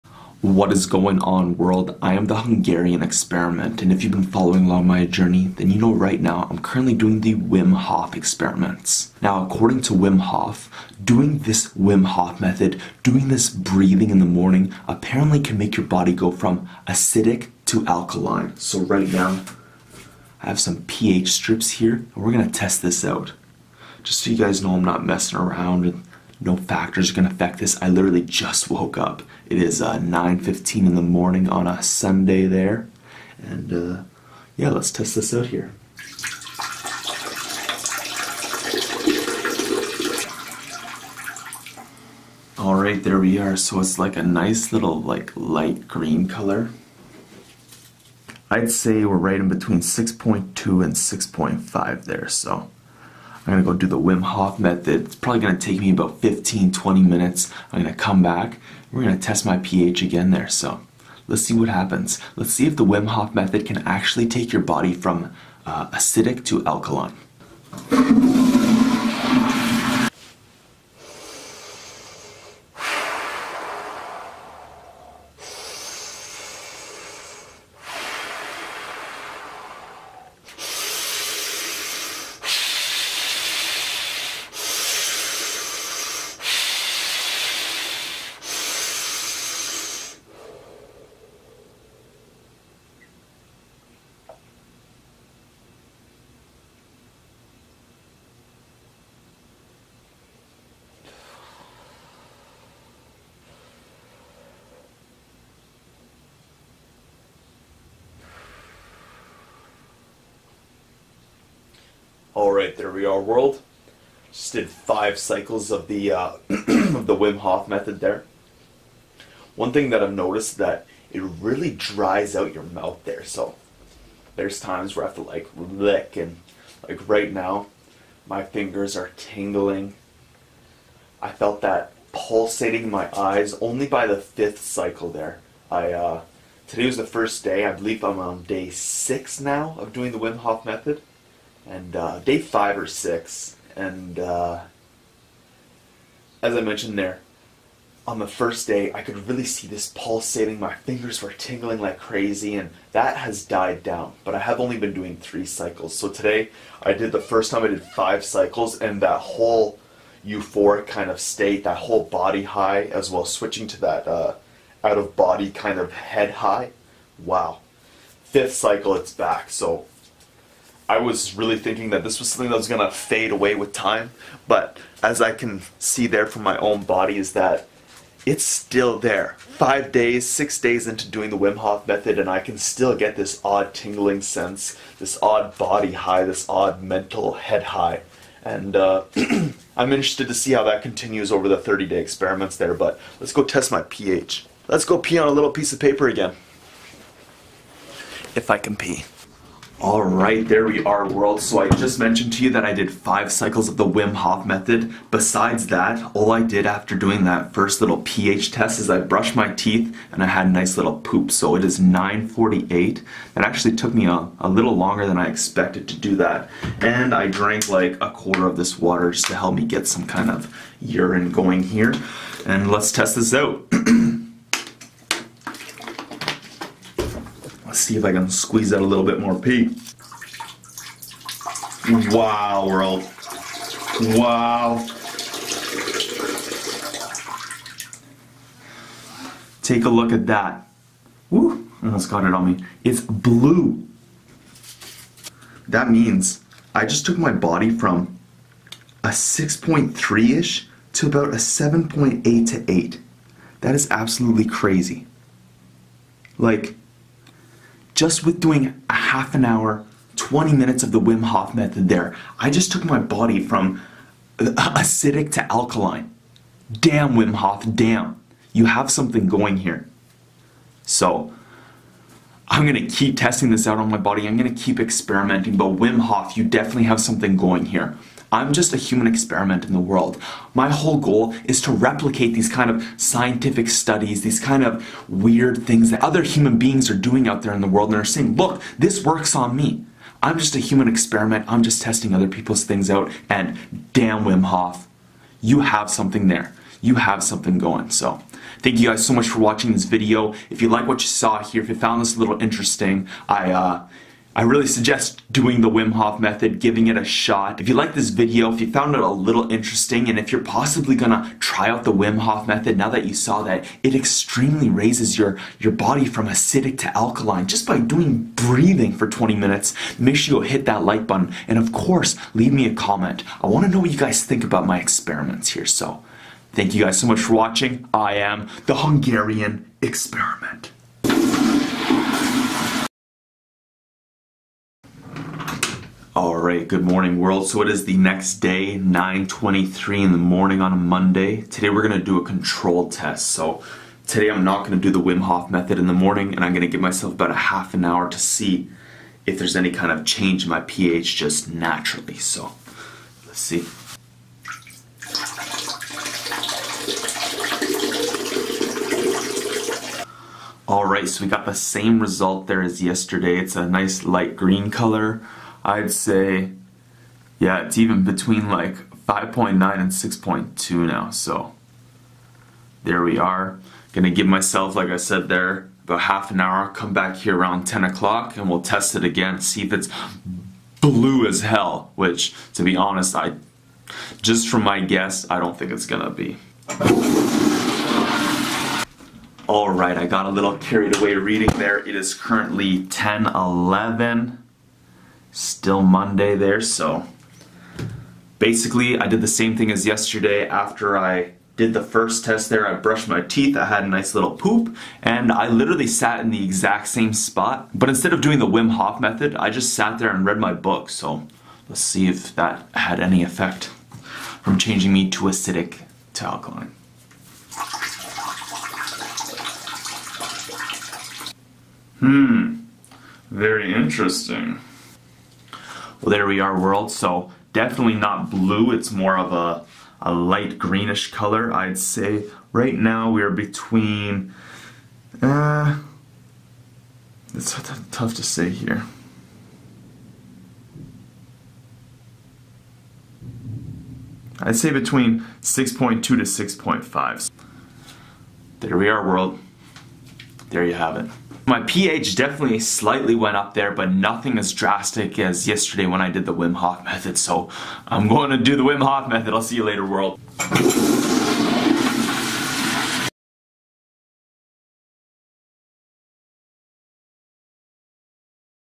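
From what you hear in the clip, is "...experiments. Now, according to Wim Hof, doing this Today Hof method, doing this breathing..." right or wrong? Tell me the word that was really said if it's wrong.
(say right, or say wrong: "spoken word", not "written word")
wrong: "Wim", not "Today".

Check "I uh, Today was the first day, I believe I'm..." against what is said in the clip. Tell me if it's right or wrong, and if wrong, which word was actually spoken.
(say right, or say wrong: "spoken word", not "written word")
right.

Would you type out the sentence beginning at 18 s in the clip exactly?
So, right now, I have some pH strips here, and we're gonna test this out.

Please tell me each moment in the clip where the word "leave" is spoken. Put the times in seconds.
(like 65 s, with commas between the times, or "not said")
322 s.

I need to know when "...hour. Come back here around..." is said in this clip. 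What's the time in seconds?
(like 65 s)
376 s.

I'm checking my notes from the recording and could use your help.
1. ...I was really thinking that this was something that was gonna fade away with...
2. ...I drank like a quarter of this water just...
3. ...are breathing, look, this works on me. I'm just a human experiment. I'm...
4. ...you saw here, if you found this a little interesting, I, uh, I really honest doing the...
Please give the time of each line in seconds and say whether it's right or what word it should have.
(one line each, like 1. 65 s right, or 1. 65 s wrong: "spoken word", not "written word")
1. 170 s right
2. 217 s right
3. 288 s wrong: "saying", not "breathing"
4. 301 s wrong: "suggest", not "honest".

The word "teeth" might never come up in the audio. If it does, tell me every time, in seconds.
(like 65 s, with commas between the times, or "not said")
209 s, 403 s.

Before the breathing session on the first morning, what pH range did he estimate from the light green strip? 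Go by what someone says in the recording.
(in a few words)
6.2 to 6.5.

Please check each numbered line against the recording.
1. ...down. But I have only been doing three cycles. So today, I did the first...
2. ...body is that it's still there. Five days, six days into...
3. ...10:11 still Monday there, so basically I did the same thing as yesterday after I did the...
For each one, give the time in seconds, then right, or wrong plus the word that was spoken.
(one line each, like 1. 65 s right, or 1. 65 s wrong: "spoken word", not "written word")
1. 153 s right
2. 176 s right
3. 392 s right.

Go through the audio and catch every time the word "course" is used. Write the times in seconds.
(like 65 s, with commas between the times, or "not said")
321 s.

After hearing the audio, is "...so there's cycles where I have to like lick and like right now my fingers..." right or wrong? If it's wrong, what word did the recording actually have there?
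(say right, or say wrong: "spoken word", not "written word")
wrong: "times", not "cycles".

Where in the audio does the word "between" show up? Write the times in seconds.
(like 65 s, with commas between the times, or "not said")
49 s, 368 s, 433 s, 444 s.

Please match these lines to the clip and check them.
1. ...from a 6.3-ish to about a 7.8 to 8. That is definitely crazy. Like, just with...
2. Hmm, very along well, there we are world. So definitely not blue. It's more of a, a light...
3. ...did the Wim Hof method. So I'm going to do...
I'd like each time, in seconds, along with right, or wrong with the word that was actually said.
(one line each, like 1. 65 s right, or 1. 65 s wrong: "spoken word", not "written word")
1. 247 s wrong: "absolutely", not "definitely"
2. 421 s wrong: "interesting", not "along"
3. 456 s right.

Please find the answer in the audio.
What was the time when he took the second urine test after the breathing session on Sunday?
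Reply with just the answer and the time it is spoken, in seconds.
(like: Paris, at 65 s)
9:48, at 211 s.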